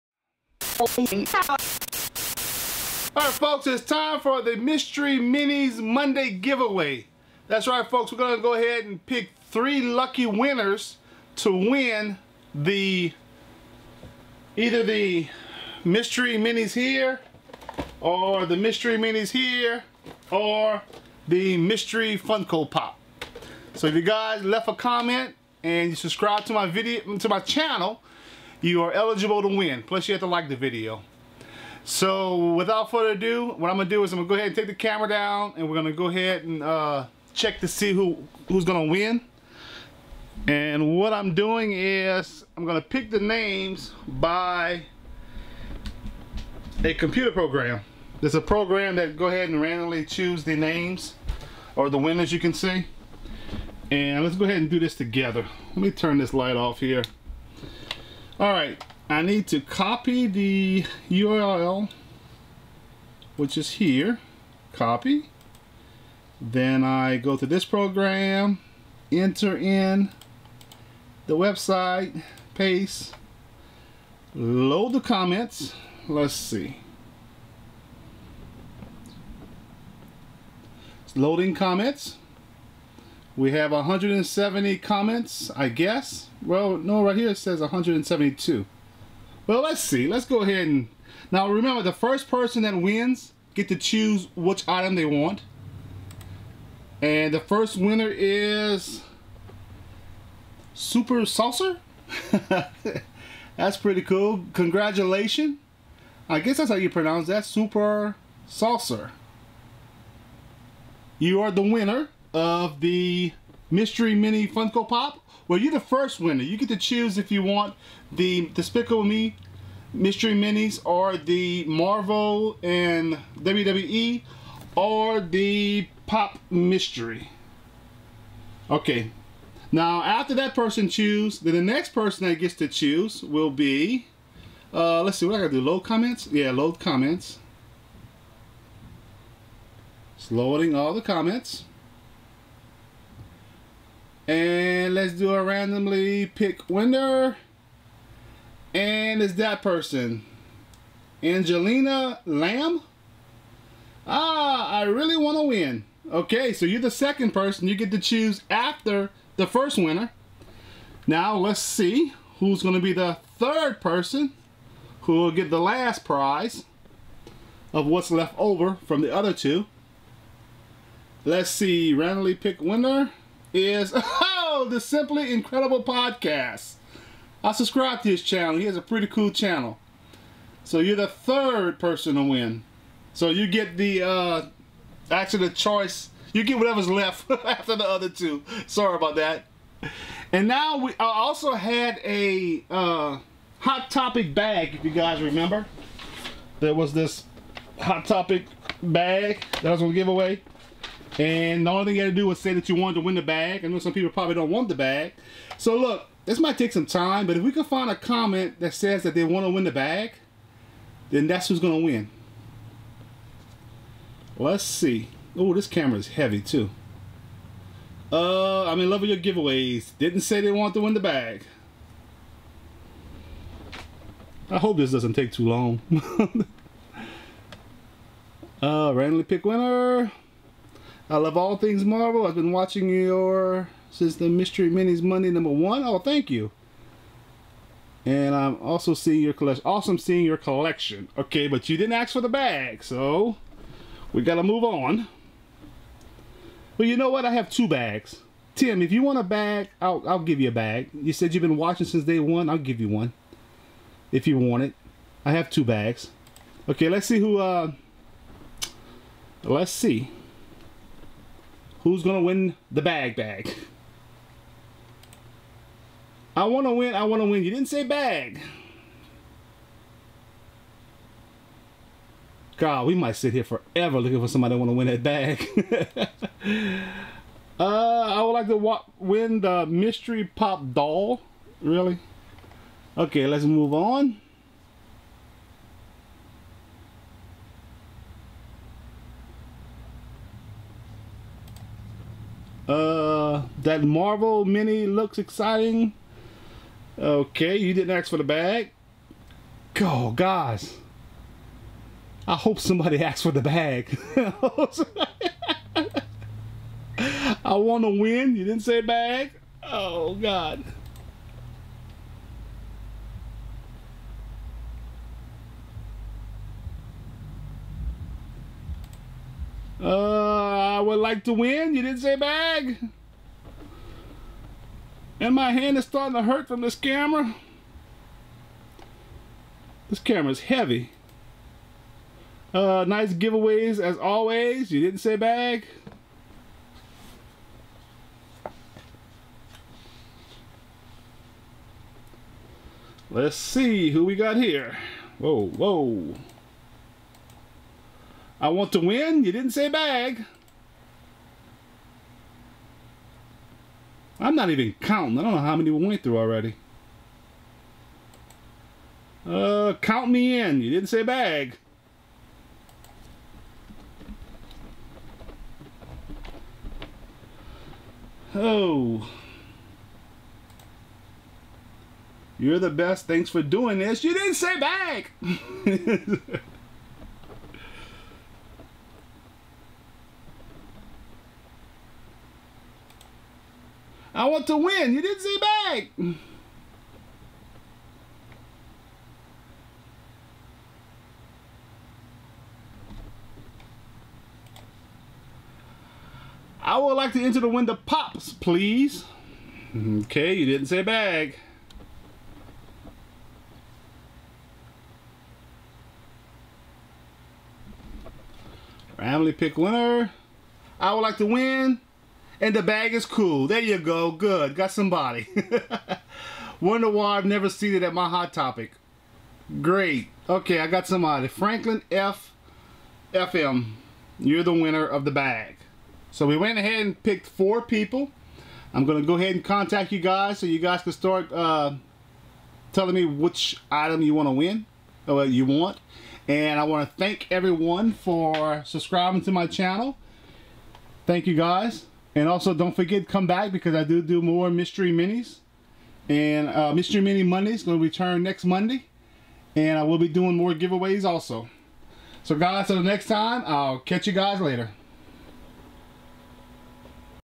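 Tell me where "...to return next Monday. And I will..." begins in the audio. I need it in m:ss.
7:27.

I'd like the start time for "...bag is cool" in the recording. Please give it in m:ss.
6:52.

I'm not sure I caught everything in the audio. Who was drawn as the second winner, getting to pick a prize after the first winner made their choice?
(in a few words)
Angelina Lamb.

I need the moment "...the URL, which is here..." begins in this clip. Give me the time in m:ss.
1:00.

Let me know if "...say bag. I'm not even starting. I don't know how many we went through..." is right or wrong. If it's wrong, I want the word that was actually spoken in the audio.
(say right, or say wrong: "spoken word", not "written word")
wrong: "counting", not "starting".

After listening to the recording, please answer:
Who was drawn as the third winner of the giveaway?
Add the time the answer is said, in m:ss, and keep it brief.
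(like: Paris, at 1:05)
The Simply Incredible Podcast, at 2:54.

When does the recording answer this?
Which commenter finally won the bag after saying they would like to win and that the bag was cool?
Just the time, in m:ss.
7:01.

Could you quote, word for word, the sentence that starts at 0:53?
And let's go ahead and do this together.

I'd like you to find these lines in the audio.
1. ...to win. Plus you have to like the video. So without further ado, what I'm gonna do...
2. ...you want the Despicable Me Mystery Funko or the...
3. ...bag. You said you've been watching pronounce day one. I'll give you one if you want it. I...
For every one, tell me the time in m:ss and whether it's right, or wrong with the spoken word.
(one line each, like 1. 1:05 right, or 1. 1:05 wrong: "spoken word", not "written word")
1. 0:29 right
2. 1:57 wrong: "Minis", not "Funko"
3. 4:10 wrong: "since", not "pronounce".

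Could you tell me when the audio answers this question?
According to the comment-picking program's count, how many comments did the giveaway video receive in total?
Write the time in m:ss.
1:27.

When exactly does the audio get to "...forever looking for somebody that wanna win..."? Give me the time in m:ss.
4:33.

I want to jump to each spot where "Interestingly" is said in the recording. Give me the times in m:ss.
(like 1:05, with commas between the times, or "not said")
not said.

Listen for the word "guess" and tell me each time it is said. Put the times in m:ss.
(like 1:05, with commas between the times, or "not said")
1:25, 1:46.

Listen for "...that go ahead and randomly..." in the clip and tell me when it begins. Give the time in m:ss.
0:48.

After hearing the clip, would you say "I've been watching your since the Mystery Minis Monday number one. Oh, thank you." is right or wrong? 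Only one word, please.
right.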